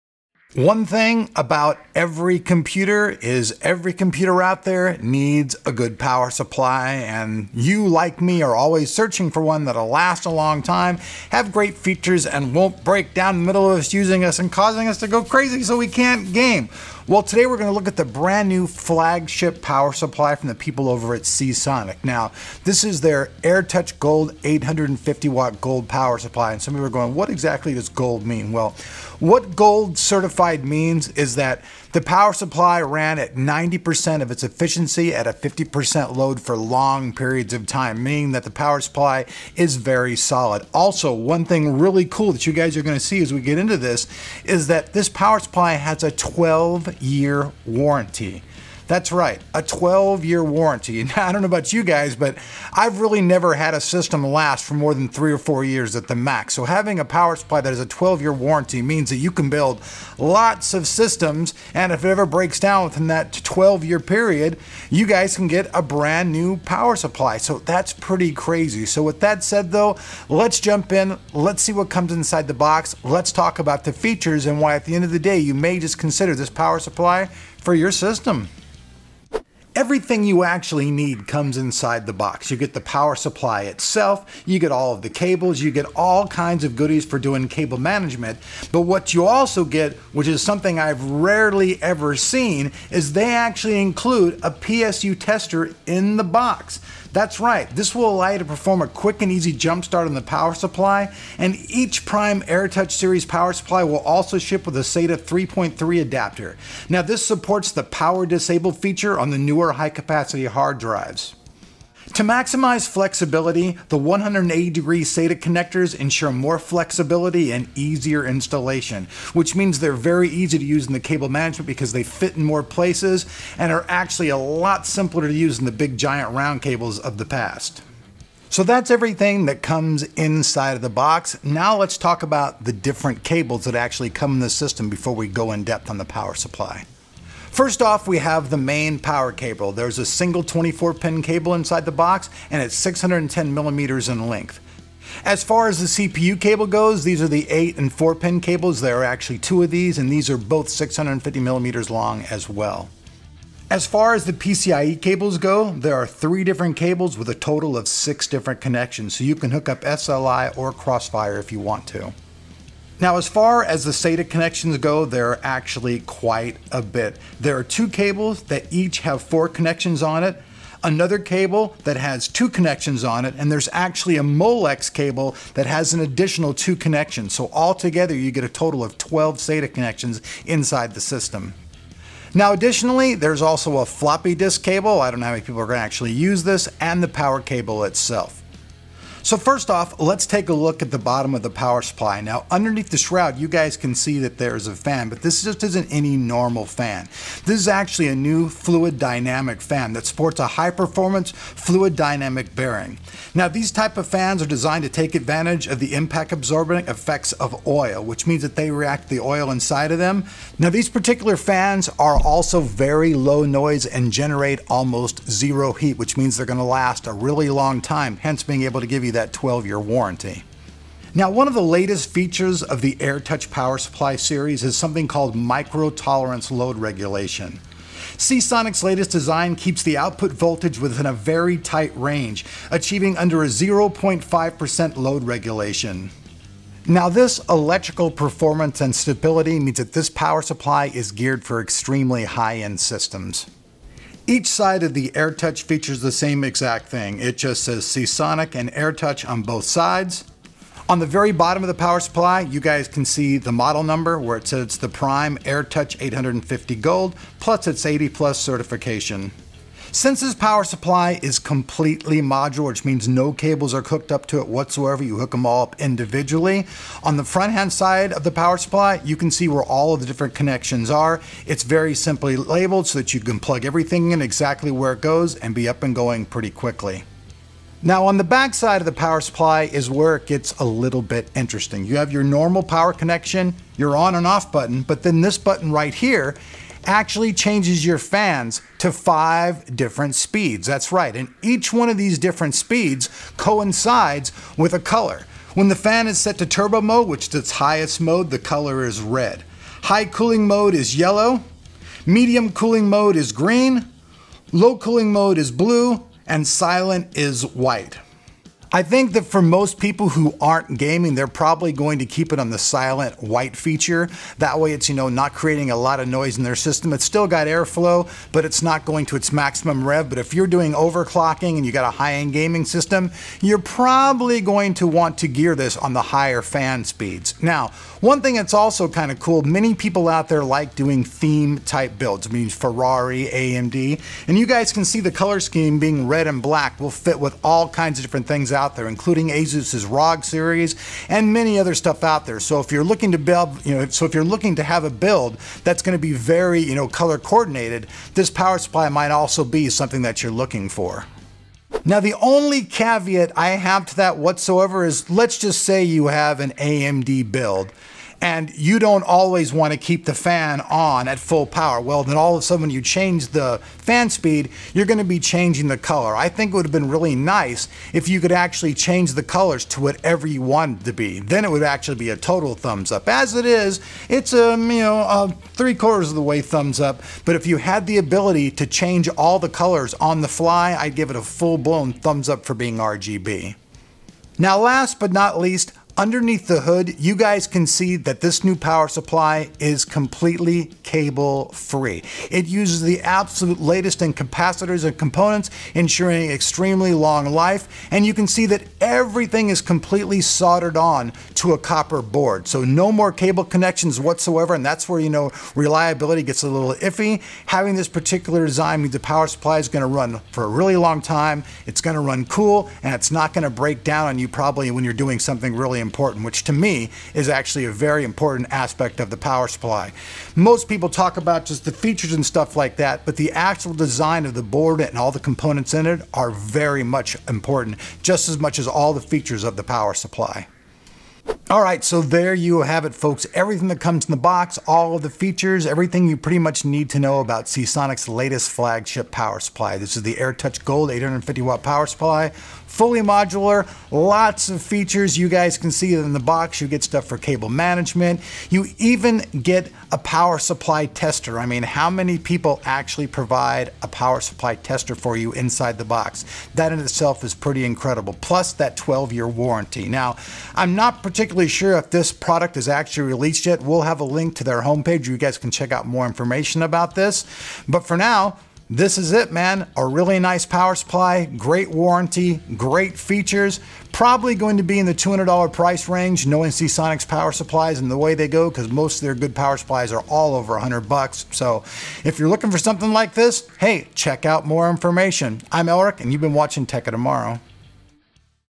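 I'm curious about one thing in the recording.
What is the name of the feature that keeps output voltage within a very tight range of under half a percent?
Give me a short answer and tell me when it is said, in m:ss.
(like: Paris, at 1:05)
micro tolerance load regulation, at 3:45.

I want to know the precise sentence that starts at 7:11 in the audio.
All right, so there you have it, folks.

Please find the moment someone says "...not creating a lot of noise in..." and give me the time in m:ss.
5:15.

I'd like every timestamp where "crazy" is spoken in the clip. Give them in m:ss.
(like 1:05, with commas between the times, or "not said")
0:15, 1:08.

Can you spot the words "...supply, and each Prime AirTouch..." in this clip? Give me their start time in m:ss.
1:40.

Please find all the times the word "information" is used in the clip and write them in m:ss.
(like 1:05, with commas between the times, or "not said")
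7:46, 8:04.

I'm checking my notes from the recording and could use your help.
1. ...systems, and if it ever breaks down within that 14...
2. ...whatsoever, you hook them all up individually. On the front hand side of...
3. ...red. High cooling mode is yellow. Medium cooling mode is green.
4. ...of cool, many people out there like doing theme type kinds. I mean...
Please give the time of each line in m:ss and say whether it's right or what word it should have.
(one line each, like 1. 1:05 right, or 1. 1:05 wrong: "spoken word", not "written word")
1. 1:00 wrong: "12", not "14"
2. 4:24 right
3. 4:59 right
4. 5:29 wrong: "builds", not "kinds".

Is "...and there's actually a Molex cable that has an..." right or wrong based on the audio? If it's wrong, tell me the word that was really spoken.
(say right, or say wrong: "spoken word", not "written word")
right.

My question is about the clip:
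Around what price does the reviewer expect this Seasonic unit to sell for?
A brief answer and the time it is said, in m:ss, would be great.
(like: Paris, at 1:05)
$200, at 7:54.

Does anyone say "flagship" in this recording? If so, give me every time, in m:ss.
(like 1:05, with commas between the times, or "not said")
0:18, 7:18.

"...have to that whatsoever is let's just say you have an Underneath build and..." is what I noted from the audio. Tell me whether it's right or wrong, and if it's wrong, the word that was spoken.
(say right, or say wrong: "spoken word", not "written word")
wrong: "AMD", not "Underneath".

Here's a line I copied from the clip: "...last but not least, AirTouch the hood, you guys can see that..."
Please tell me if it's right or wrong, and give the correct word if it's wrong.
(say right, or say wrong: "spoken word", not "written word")
wrong: "Underneath", not "AirTouch".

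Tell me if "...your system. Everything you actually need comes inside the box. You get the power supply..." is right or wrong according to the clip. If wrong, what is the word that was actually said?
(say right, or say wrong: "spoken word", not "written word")
right.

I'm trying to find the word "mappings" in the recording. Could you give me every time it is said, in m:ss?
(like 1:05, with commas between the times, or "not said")
not said.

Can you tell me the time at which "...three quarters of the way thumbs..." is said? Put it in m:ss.
6:15.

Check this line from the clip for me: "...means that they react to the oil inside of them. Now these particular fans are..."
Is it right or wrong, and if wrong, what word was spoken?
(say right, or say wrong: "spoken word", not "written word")
right.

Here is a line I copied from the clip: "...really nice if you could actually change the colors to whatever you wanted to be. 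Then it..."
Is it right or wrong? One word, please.
right.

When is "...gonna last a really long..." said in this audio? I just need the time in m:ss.
3:36.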